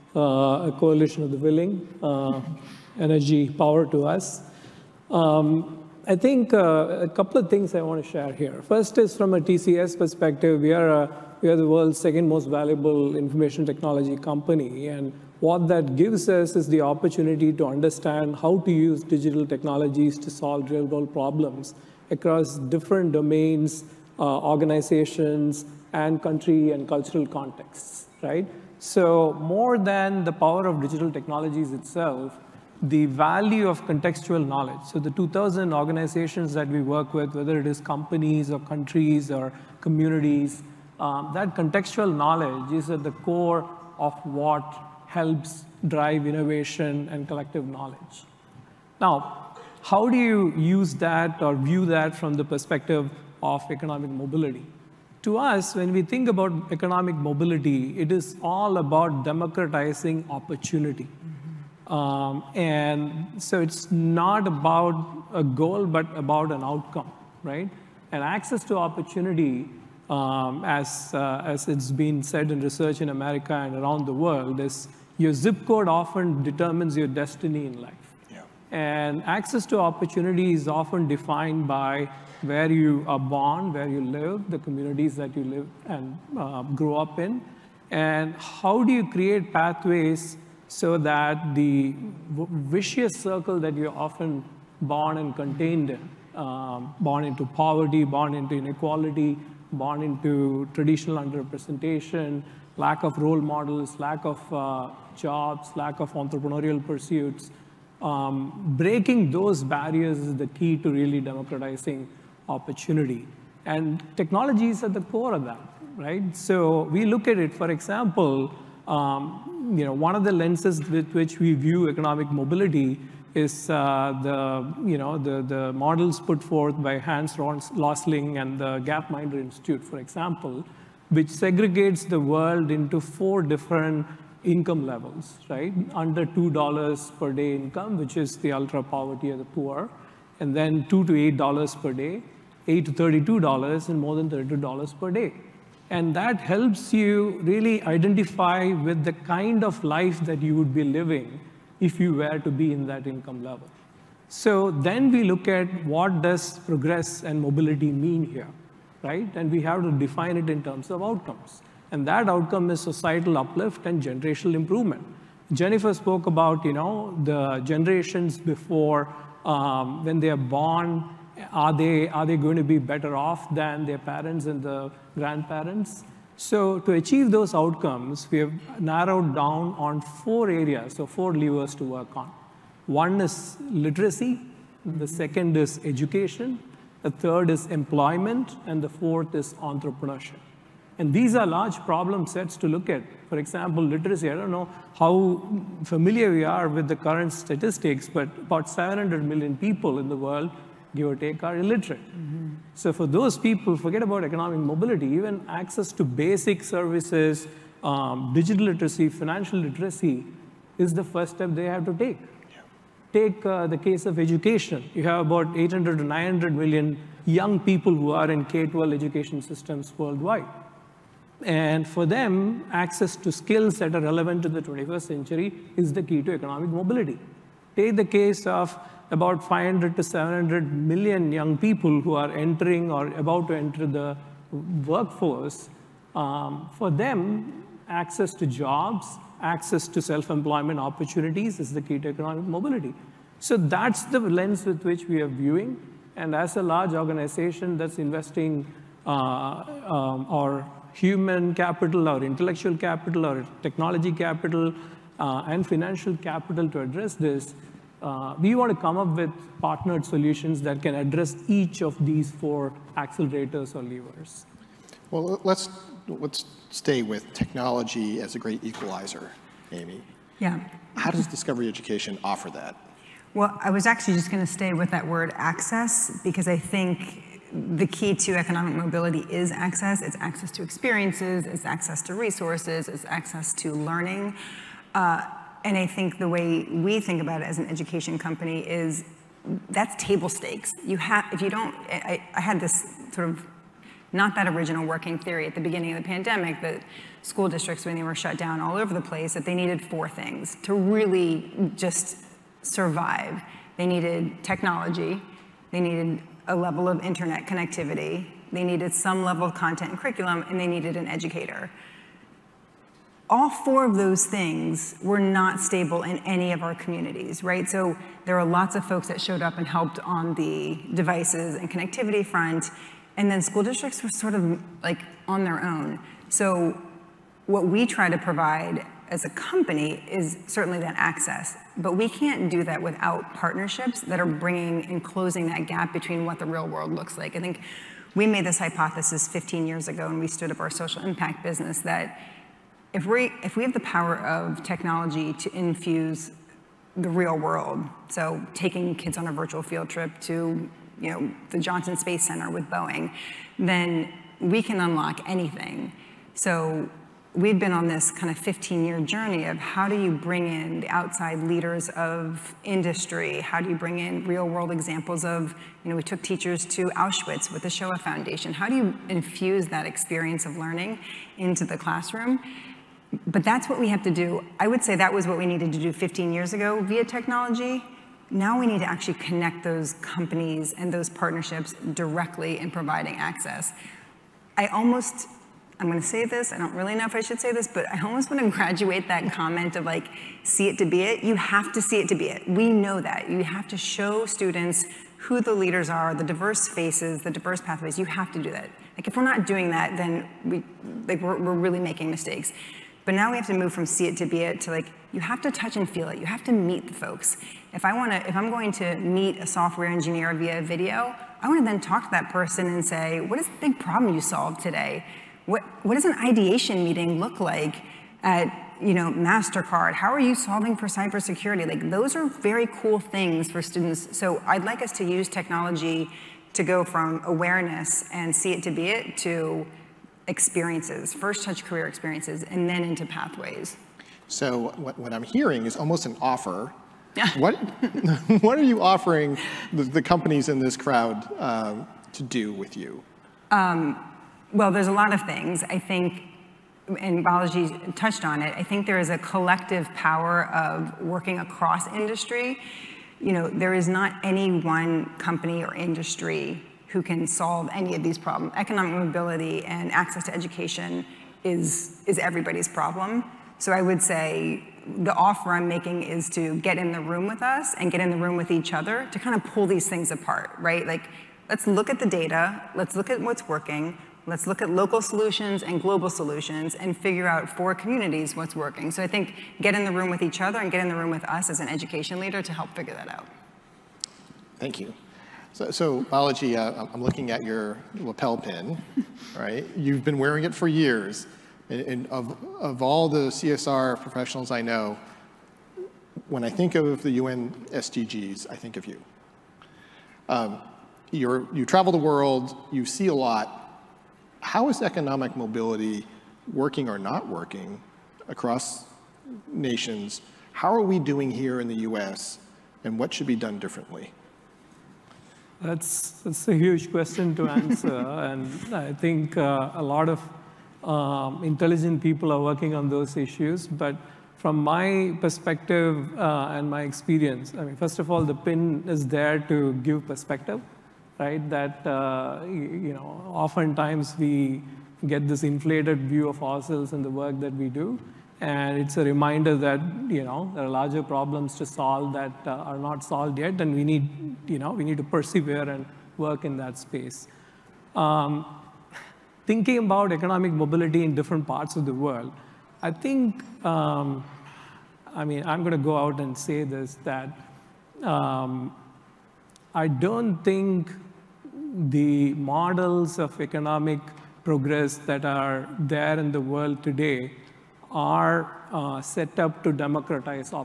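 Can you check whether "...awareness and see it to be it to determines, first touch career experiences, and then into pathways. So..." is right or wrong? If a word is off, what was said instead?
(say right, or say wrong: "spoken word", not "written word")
wrong: "experiences", not "determines".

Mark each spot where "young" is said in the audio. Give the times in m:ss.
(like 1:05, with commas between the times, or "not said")
3:37, 3:51.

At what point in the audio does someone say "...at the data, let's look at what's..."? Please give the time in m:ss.
7:51.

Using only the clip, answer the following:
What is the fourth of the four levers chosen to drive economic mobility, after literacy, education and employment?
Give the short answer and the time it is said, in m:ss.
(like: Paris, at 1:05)
Entrepreneurship, at 3:09.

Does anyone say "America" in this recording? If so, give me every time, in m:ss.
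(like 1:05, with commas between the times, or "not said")
1:13.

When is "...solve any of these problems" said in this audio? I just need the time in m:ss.
7:37.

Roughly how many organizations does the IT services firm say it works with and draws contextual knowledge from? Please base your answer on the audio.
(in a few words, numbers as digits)
2,000.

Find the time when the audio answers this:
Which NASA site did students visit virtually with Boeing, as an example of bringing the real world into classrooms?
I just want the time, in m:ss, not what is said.
5:51.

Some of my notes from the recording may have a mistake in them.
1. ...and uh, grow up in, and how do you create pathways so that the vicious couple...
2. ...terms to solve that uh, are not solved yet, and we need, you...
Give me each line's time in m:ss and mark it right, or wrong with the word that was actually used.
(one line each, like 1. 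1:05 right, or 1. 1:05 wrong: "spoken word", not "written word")
1. 1:25 wrong: "circle", not "couple"
2. 9:01 wrong: "problems", not "terms".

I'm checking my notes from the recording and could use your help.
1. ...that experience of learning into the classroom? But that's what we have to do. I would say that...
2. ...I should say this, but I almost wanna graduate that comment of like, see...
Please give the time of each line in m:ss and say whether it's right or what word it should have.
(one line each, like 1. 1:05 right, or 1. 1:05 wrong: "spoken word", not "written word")
1. 6:09 right
2. 6:27 right.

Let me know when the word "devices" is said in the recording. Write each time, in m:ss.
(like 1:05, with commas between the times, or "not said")
5:20.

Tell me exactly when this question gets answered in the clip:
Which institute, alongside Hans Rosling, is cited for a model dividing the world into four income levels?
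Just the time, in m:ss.
2:08.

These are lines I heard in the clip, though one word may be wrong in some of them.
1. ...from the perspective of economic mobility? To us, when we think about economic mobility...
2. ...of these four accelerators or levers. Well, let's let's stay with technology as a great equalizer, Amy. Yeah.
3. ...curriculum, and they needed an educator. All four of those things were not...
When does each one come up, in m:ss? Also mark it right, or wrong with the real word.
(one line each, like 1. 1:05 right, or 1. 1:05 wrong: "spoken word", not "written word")
1. 0:52 right
2. 4:21 right
3. 5:09 right.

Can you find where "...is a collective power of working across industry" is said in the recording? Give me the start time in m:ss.
7:28.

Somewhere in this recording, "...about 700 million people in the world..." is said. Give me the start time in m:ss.
3:18.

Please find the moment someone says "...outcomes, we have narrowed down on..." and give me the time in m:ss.
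2:57.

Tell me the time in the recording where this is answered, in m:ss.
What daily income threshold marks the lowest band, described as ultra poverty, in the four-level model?
2:16.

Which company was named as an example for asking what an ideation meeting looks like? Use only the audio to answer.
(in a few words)
MasterCard.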